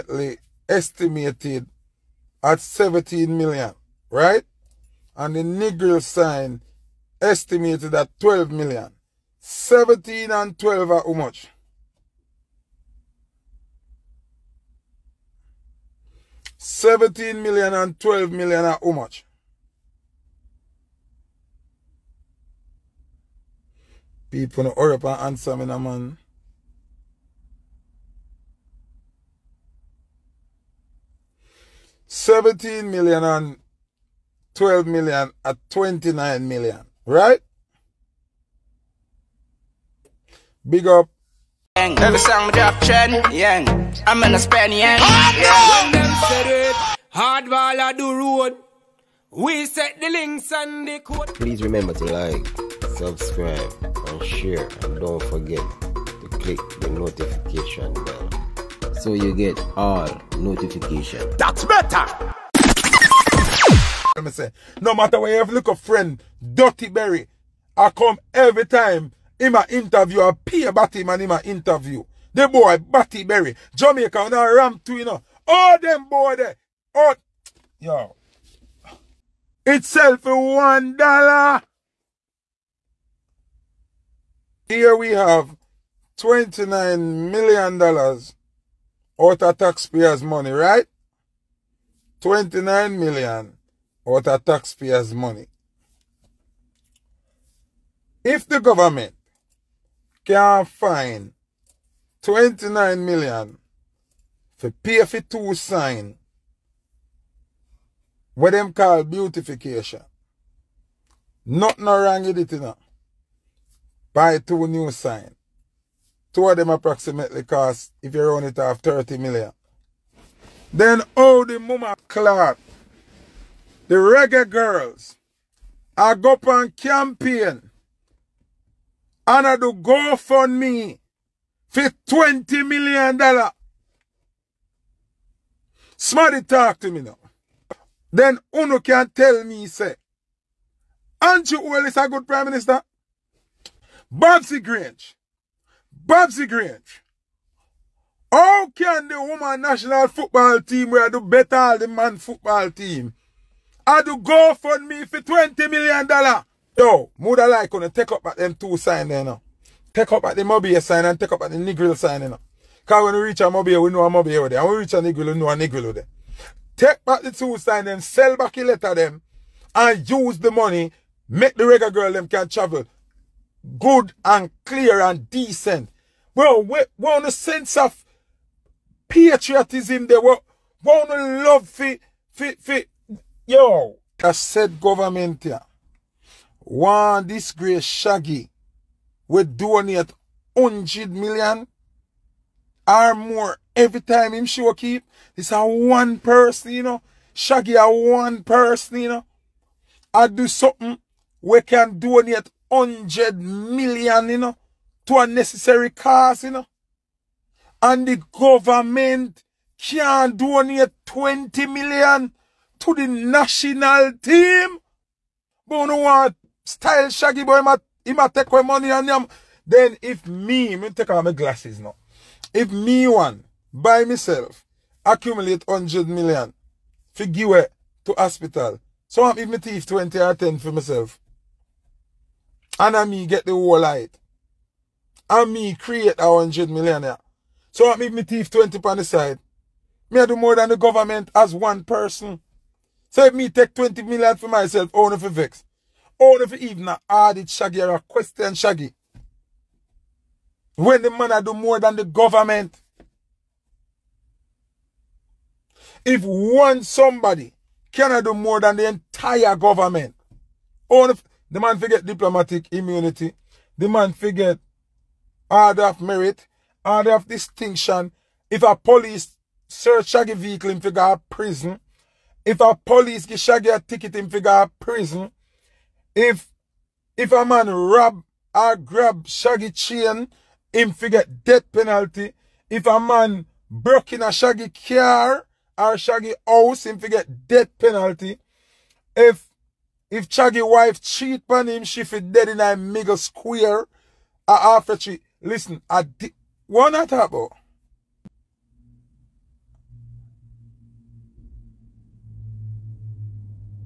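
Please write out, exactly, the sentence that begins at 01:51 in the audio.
Nothing wrong with it, you know.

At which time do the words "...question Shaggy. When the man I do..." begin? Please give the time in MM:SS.
04:07.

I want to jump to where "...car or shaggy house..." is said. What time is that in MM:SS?
04:44.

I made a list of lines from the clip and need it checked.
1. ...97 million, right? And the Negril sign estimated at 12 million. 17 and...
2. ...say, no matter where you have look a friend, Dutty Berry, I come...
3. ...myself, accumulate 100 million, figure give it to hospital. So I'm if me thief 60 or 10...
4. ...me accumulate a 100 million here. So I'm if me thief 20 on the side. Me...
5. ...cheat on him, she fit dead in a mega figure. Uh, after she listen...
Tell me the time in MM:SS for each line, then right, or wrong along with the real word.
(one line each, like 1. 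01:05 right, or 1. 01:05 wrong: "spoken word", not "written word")
1. 00:02 wrong: "17", not "97"
2. 01:04 right
3. 03:44 wrong: "20", not "60"
4. 03:55 wrong: "create", not "accumulate"
5. 04:50 wrong: "square", not "figure".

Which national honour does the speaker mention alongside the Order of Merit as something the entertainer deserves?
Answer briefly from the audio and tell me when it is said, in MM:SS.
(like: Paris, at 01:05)
Order of Distinction, at 04:26.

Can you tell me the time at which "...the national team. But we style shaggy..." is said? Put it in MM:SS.
03:32.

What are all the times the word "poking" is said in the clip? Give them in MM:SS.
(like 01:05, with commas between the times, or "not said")
not said.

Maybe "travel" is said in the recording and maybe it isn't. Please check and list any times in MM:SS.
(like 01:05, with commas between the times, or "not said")
02:52.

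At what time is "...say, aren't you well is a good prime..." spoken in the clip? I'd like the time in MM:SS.
02:19.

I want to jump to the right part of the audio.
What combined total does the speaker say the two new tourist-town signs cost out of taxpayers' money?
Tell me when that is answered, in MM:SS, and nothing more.
00:35.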